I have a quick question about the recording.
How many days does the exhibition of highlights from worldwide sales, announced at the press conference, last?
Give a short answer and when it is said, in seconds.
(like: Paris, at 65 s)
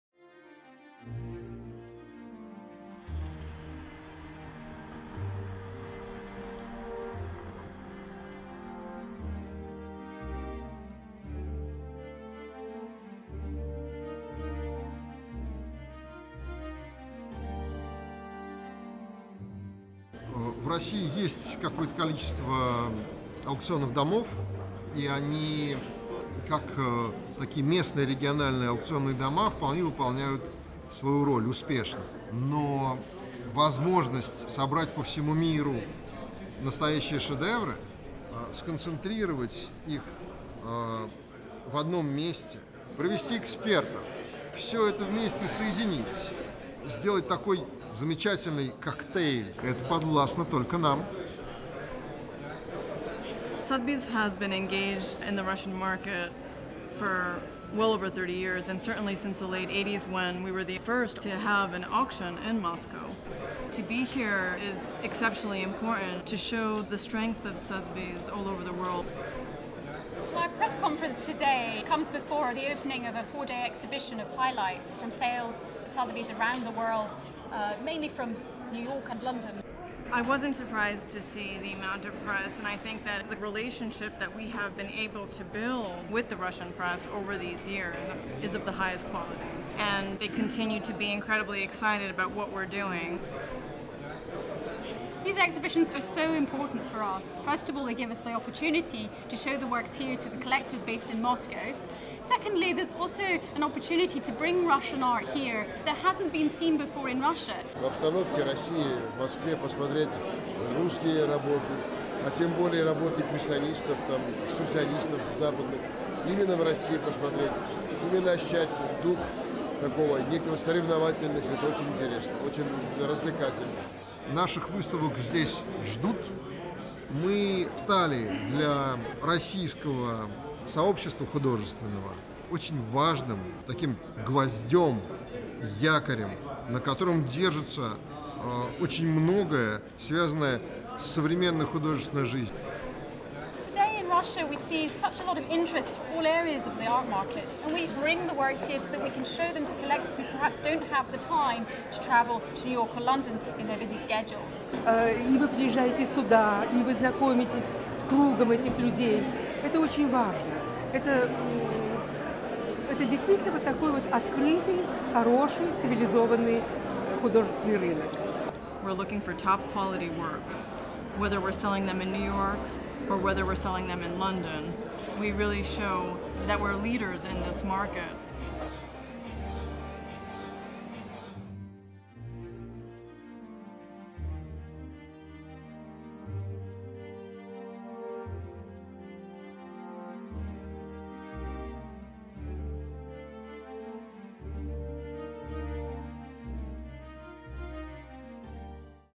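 4 days, at 73 s.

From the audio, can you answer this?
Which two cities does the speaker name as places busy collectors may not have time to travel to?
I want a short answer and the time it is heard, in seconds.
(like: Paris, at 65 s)
New York and London, at 152 s.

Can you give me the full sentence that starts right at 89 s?
And they continue to be incredibly excited about what we're doing these exhibitions are so important for us.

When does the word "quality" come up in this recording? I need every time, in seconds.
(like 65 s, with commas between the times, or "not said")
89 s, 169 s.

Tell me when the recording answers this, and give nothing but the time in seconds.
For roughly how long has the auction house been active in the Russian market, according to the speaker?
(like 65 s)
57 s.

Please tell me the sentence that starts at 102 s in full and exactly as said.
Secondly, there's also an opportunity to bring Russian art here that hasn't been seen before in Russia.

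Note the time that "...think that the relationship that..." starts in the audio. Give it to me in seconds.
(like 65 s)
82 s.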